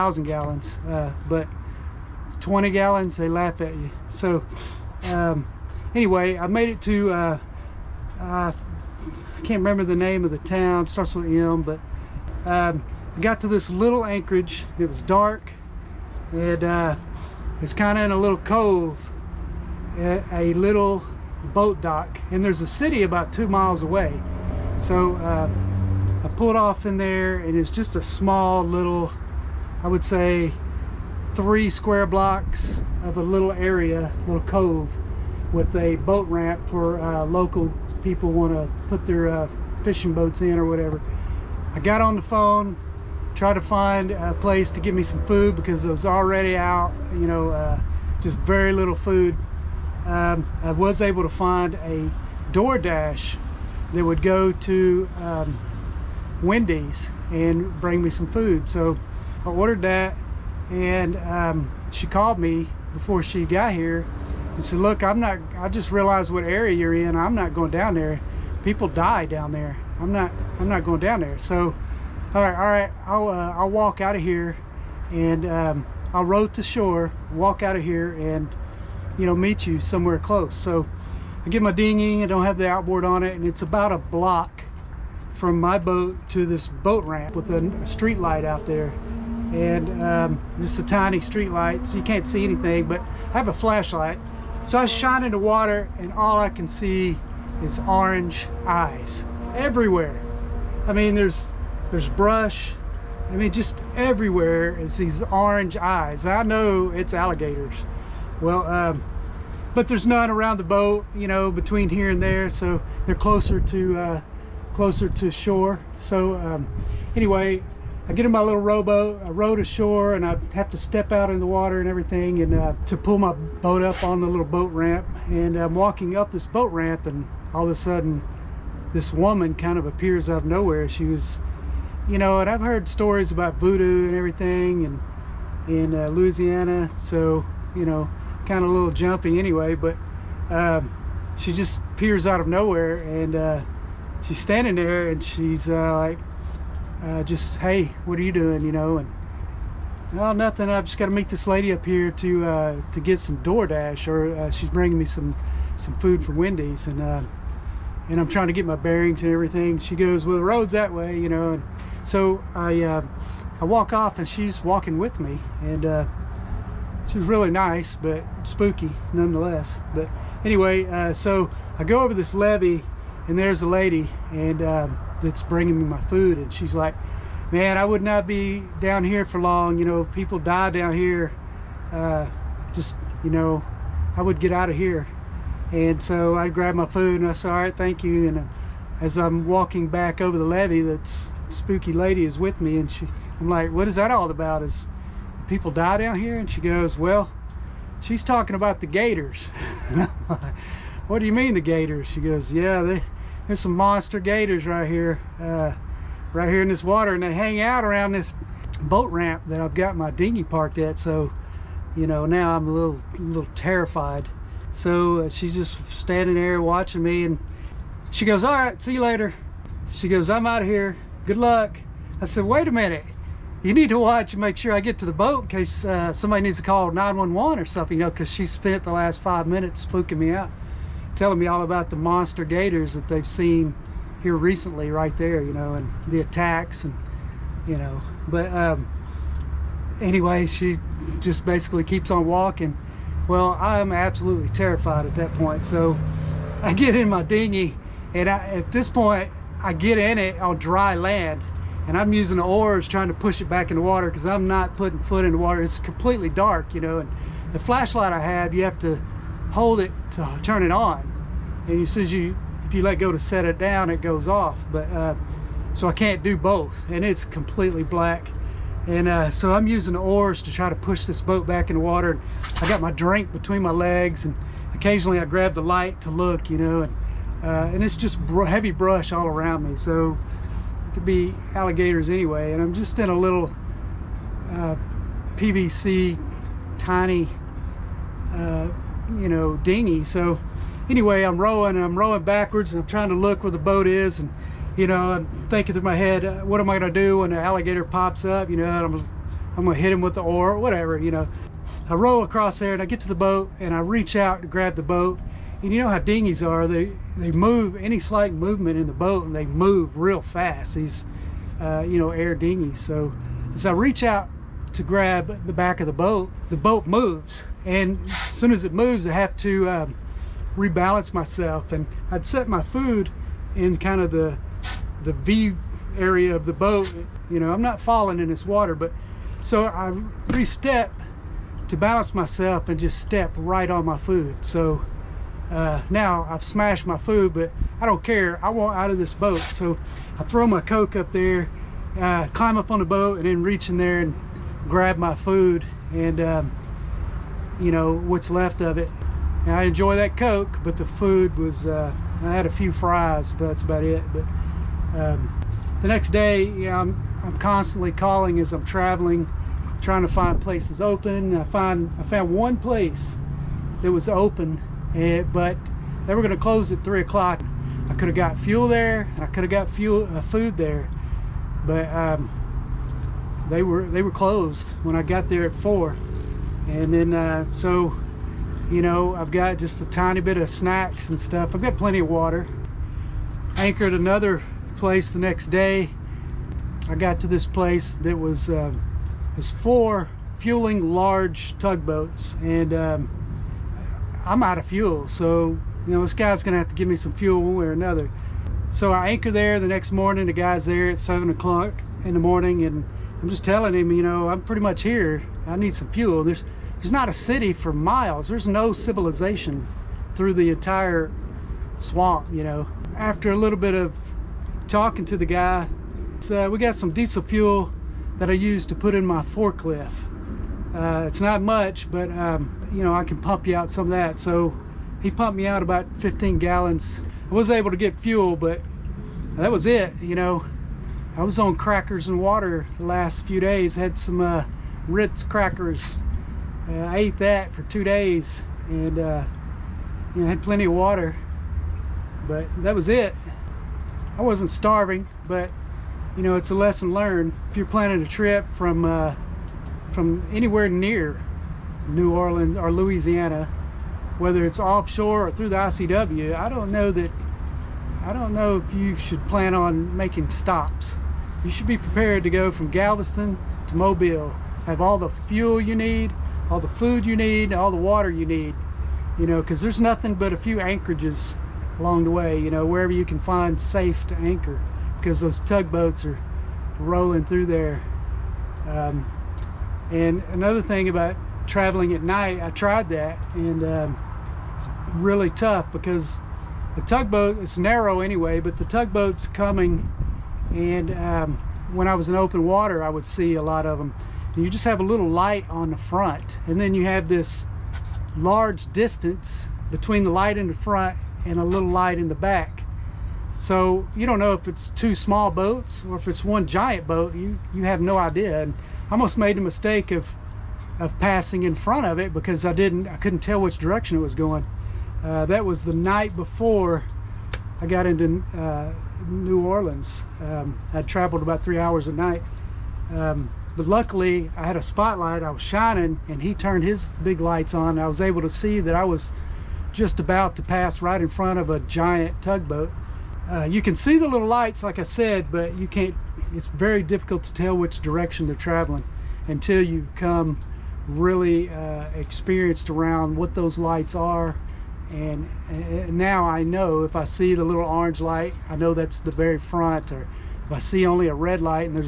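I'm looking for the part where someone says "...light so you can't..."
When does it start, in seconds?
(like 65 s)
91 s.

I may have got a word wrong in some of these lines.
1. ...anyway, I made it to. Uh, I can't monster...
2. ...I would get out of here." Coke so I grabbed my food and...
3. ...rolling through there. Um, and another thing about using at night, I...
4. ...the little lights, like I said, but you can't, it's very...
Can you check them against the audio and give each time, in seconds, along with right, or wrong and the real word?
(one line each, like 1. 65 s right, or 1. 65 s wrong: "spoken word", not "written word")
1. 5 s wrong: "remember", not "monster"
2. 184 s wrong: "And", not "Coke"
3. 476 s wrong: "traveling", not "using"
4. 533 s right.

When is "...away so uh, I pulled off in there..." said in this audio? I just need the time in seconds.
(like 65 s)
23 s.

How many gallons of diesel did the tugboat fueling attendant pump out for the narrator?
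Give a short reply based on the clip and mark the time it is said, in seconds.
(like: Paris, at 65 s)
15, at 425 s.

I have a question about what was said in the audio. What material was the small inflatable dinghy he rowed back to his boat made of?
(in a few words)
PVC.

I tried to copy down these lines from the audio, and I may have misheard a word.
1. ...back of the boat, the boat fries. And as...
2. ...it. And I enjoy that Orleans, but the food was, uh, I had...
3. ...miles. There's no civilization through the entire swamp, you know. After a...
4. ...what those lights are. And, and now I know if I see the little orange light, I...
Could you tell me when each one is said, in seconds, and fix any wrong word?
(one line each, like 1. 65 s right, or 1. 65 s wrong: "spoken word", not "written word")
1. 315 s wrong: "moves", not "fries"
2. 348 s wrong: "Coke", not "Orleans"
3. 407 s right
4. 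543 s right.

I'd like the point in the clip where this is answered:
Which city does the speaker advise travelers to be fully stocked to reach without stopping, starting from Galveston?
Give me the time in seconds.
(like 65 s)
463 s.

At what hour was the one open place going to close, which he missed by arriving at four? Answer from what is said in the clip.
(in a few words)
3 o'clock.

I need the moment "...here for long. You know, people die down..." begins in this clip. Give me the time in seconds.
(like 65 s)
179 s.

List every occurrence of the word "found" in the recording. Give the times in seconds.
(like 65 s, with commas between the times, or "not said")
362 s.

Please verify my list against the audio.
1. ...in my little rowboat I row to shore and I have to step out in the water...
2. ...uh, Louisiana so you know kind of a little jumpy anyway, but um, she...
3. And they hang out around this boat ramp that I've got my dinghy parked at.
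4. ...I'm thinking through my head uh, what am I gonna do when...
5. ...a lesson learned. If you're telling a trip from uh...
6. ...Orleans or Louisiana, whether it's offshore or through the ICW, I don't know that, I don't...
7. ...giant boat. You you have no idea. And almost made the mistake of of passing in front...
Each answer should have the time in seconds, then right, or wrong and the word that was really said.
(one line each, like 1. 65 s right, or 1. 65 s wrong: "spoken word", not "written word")
1. 118 s right
2. 135 s right
3. 207 s right
4. 295 s right
5. 446 s wrong: "planning", not "telling"
6. 452 s right
7. 506 s right.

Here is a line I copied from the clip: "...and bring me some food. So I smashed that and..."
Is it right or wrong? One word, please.
wrong.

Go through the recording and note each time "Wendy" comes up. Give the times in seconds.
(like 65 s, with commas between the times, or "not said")
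56 s, 156 s.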